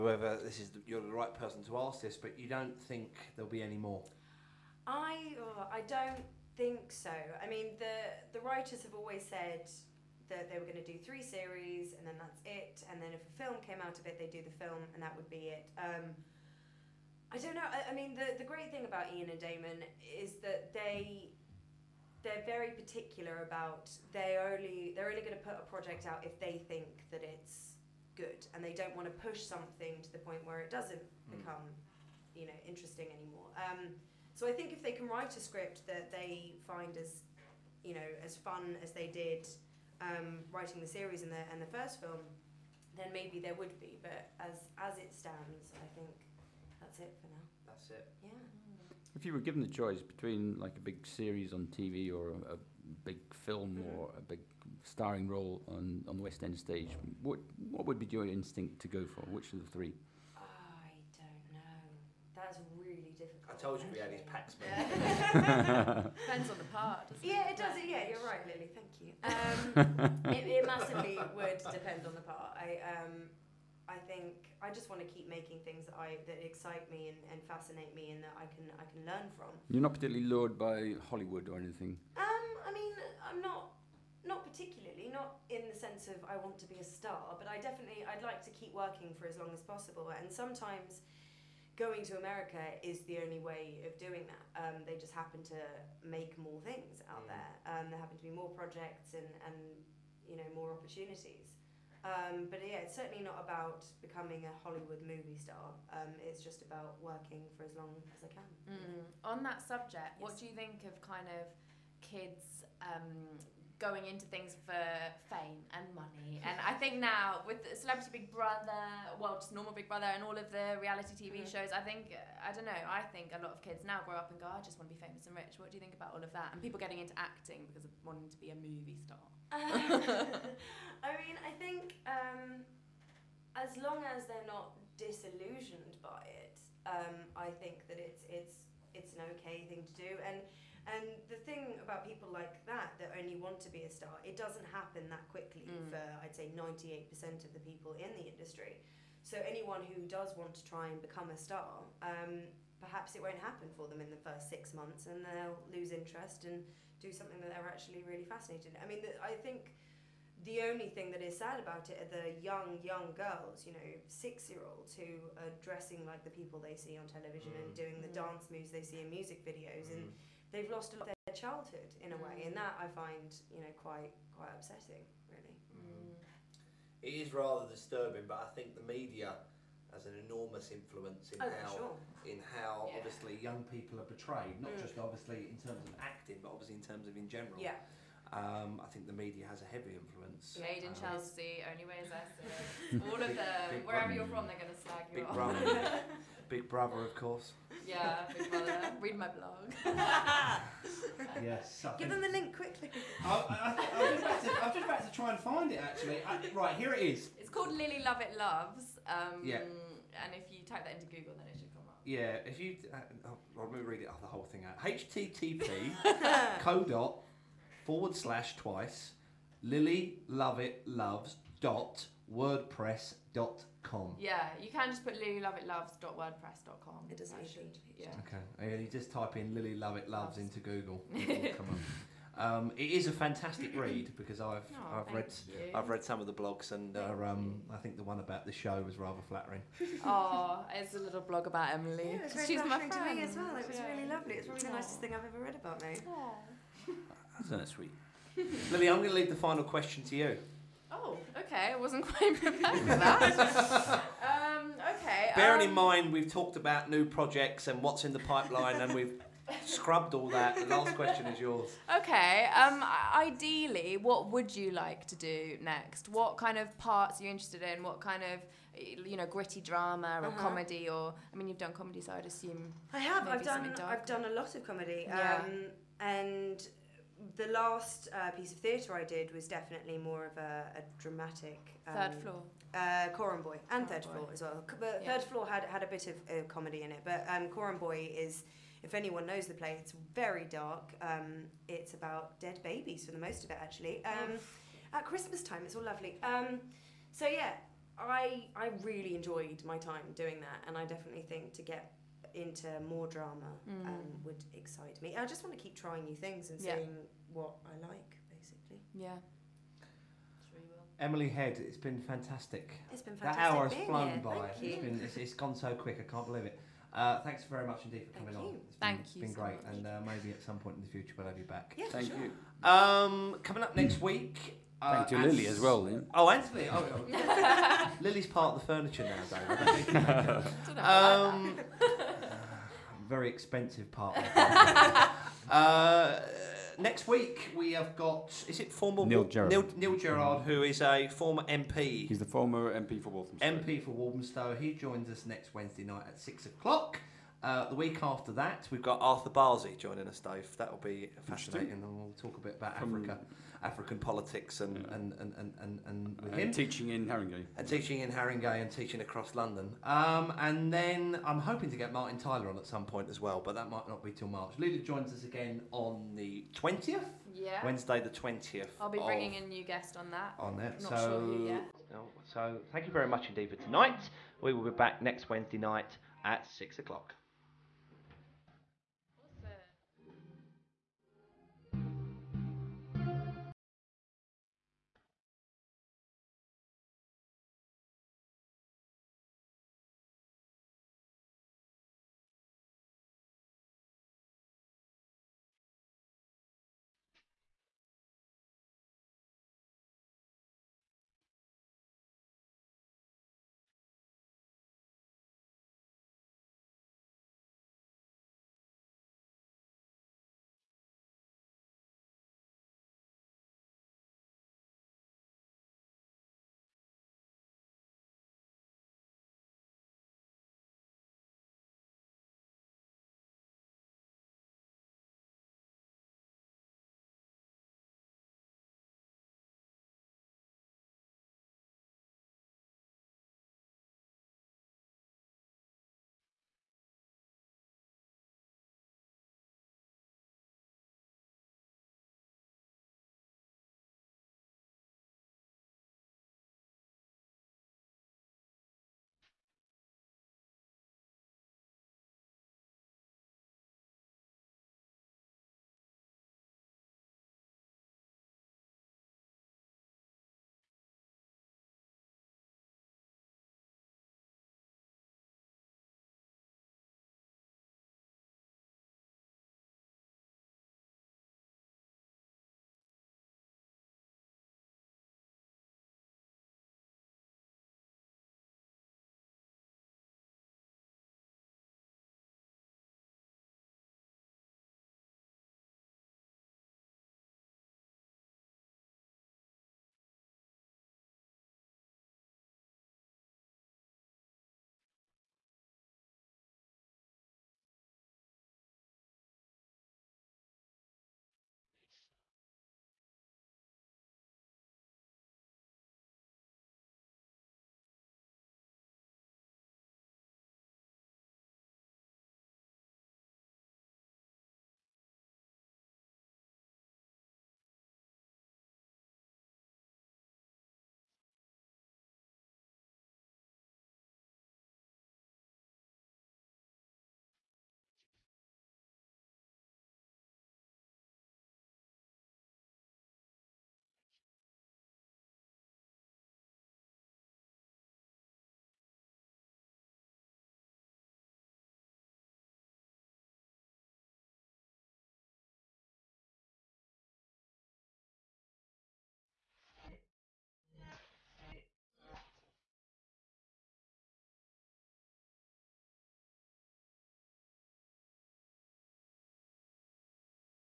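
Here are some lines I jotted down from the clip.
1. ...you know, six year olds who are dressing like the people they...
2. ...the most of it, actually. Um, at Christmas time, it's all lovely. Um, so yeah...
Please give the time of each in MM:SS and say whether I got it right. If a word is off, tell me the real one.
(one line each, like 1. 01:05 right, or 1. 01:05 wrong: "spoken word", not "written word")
1. 02:43 right
2. 04:53 right.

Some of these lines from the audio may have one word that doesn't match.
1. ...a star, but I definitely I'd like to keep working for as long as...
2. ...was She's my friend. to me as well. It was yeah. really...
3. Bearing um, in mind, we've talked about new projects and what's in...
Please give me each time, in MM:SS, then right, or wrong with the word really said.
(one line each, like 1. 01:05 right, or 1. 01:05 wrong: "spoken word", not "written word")
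1. 01:26 right
2. 04:02 right
3. 04:15 right.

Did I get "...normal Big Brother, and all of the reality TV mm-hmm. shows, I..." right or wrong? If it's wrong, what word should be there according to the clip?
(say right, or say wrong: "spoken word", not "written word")
right.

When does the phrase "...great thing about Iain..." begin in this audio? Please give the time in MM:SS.
00:18.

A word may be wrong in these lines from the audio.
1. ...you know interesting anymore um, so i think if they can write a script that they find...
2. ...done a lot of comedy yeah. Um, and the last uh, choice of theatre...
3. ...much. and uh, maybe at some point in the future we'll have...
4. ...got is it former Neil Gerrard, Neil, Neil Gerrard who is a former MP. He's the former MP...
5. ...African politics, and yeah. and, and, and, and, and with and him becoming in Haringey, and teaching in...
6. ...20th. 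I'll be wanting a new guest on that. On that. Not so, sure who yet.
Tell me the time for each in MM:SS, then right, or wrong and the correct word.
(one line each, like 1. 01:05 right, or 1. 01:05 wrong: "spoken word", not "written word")
1. 00:32 right
2. 04:34 wrong: "piece", not "choice"
3. 05:19 right
4. 05:37 right
5. 05:53 wrong: "teaching", not "becoming"
6. 06:08 wrong: "bringing", not "wanting".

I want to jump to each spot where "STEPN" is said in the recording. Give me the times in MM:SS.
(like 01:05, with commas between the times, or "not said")
not said.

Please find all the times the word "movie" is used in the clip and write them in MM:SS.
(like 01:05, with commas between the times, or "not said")
01:45, 02:08.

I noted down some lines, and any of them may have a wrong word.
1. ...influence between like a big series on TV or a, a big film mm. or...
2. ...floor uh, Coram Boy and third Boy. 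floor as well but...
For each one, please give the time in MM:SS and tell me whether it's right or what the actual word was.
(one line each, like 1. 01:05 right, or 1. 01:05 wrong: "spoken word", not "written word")
1. 00:49 wrong: "choice", not "influence"
2. 04:42 right.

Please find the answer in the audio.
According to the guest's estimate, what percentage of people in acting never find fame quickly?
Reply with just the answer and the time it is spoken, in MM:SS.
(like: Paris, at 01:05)
98, at 02:26.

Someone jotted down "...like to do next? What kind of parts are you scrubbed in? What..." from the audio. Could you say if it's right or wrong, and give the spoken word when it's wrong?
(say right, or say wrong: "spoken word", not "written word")
wrong: "interested", not "scrubbed".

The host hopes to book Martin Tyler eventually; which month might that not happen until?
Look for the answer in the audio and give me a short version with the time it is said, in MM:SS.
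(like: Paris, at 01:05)
March, at 06:04.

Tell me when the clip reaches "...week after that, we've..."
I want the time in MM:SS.
05:47.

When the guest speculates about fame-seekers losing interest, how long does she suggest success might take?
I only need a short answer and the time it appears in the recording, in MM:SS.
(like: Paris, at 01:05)
6 months, at 02:34.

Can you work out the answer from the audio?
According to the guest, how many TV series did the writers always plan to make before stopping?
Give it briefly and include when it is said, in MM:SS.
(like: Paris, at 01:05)
3, at 00:10.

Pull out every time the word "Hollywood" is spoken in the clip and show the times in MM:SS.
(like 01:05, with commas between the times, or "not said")
01:21, 01:44.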